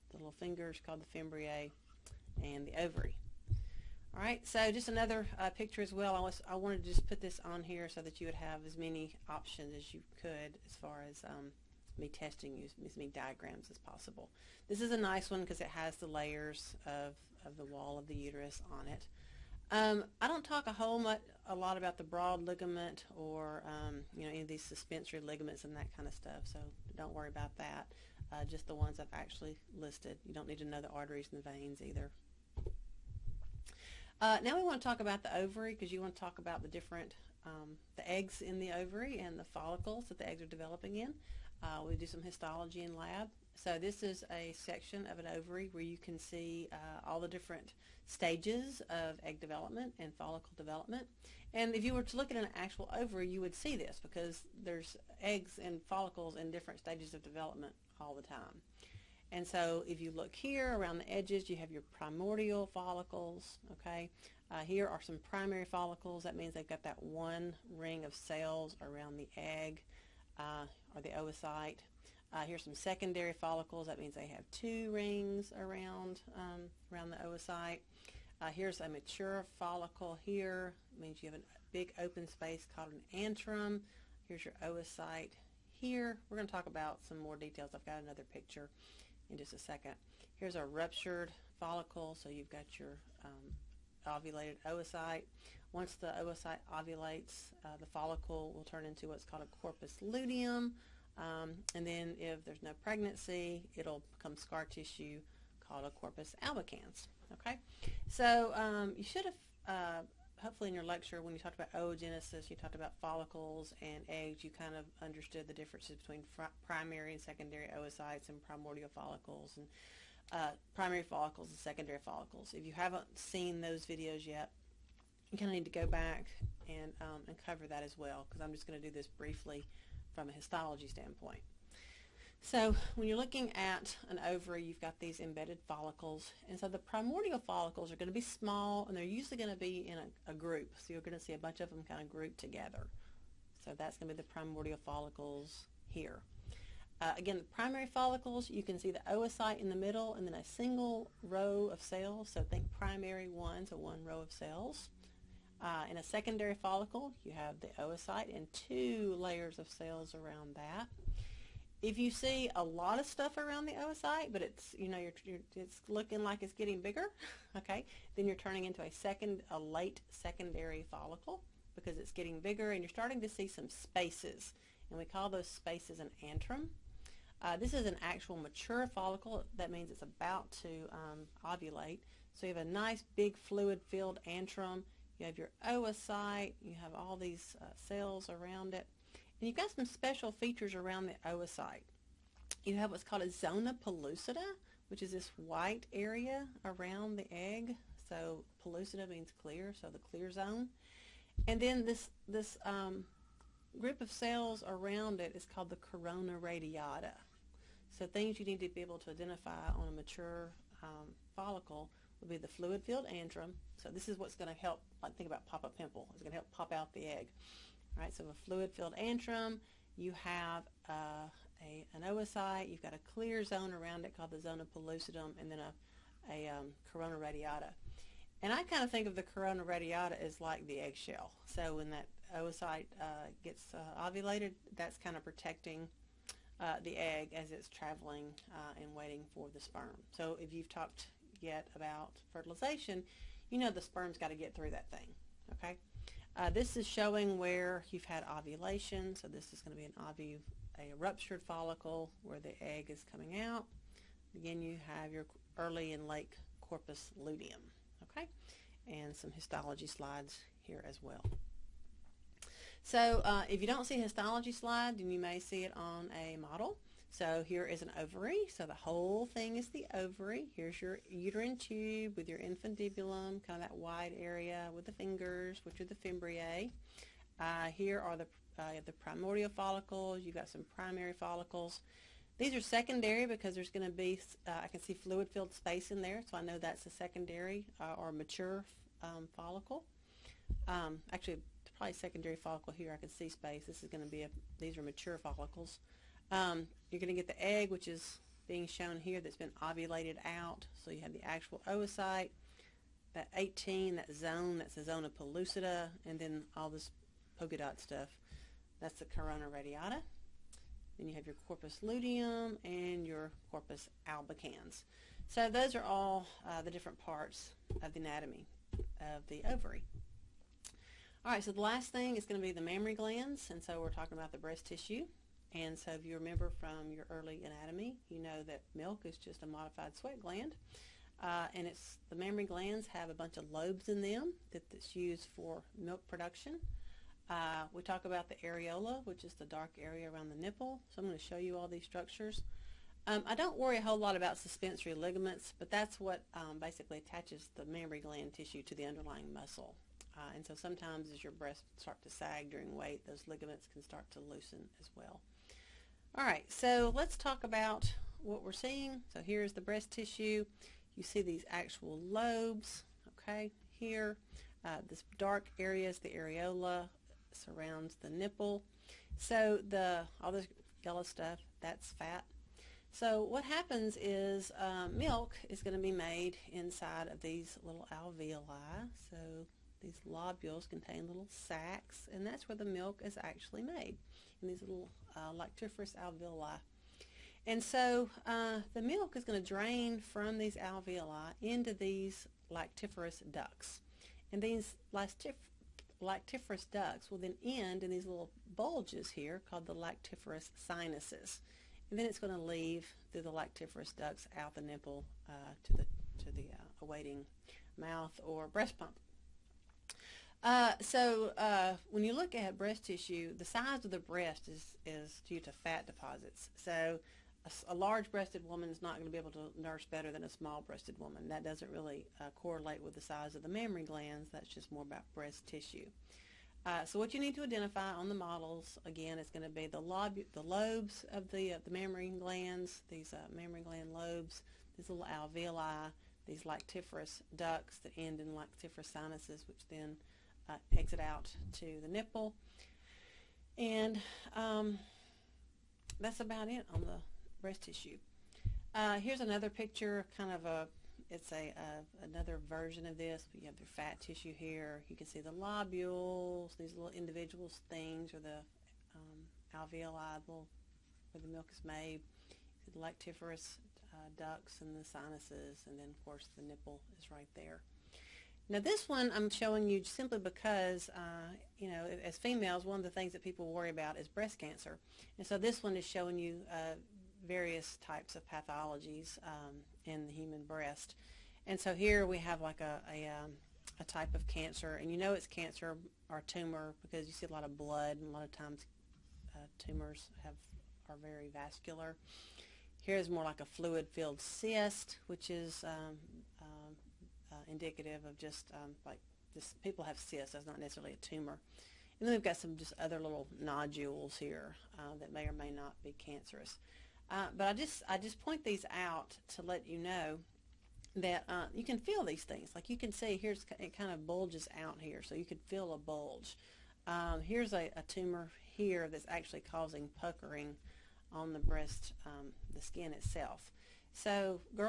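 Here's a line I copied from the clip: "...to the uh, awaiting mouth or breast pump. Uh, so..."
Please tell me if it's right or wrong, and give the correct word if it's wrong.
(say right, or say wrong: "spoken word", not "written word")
right.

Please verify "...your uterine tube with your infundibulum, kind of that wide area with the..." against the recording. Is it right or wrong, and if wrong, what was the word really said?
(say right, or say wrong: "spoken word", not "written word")
right.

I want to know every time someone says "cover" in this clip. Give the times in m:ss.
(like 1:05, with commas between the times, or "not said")
2:07.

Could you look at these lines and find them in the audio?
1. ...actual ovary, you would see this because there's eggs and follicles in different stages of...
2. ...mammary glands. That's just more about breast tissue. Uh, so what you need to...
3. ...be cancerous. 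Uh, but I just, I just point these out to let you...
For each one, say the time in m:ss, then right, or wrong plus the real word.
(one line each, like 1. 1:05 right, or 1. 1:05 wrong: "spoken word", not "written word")
1. 0:52 right
2. 7:03 right
3. 8:25 right.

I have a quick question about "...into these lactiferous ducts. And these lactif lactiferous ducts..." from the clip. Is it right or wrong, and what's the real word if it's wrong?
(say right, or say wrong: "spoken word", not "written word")
right.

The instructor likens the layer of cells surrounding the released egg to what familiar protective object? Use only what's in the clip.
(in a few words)
eggshell.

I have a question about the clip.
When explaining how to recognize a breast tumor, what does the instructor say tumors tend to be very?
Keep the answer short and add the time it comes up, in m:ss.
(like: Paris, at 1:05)
vascular, at 8:11.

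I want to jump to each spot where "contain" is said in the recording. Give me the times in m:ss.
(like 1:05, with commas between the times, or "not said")
6:20.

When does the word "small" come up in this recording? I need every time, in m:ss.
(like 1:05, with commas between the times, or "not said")
2:18, 7:00.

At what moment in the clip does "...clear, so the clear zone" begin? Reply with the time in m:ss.
3:19.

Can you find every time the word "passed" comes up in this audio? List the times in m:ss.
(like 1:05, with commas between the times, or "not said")
not said.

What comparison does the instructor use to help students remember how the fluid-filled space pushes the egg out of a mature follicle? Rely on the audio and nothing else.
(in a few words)
pop-up pimple.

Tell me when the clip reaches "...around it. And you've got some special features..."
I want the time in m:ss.
3:08.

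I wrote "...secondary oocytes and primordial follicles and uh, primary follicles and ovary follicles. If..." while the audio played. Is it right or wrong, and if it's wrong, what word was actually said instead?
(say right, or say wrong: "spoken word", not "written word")
wrong: "secondary", not "ovary".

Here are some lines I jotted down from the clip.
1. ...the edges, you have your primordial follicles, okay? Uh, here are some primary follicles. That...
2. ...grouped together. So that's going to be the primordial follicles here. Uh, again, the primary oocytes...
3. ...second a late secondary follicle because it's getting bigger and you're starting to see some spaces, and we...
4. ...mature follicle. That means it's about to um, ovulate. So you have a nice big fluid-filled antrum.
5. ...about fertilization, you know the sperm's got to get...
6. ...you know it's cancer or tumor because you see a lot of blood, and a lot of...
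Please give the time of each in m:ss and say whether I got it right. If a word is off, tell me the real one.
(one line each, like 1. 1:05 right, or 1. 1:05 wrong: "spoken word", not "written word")
1. 1:00 right
2. 2:22 wrong: "follicles", not "oocytes"
3. 2:48 right
4. 2:58 right
5. 4:01 right
6. 8:04 right.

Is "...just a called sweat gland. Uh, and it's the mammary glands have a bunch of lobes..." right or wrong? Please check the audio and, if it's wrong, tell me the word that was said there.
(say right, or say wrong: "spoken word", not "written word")
wrong: "modified", not "called".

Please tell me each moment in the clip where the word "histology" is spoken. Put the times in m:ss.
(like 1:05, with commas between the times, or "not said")
0:42, 2:10, 4:19, 4:24.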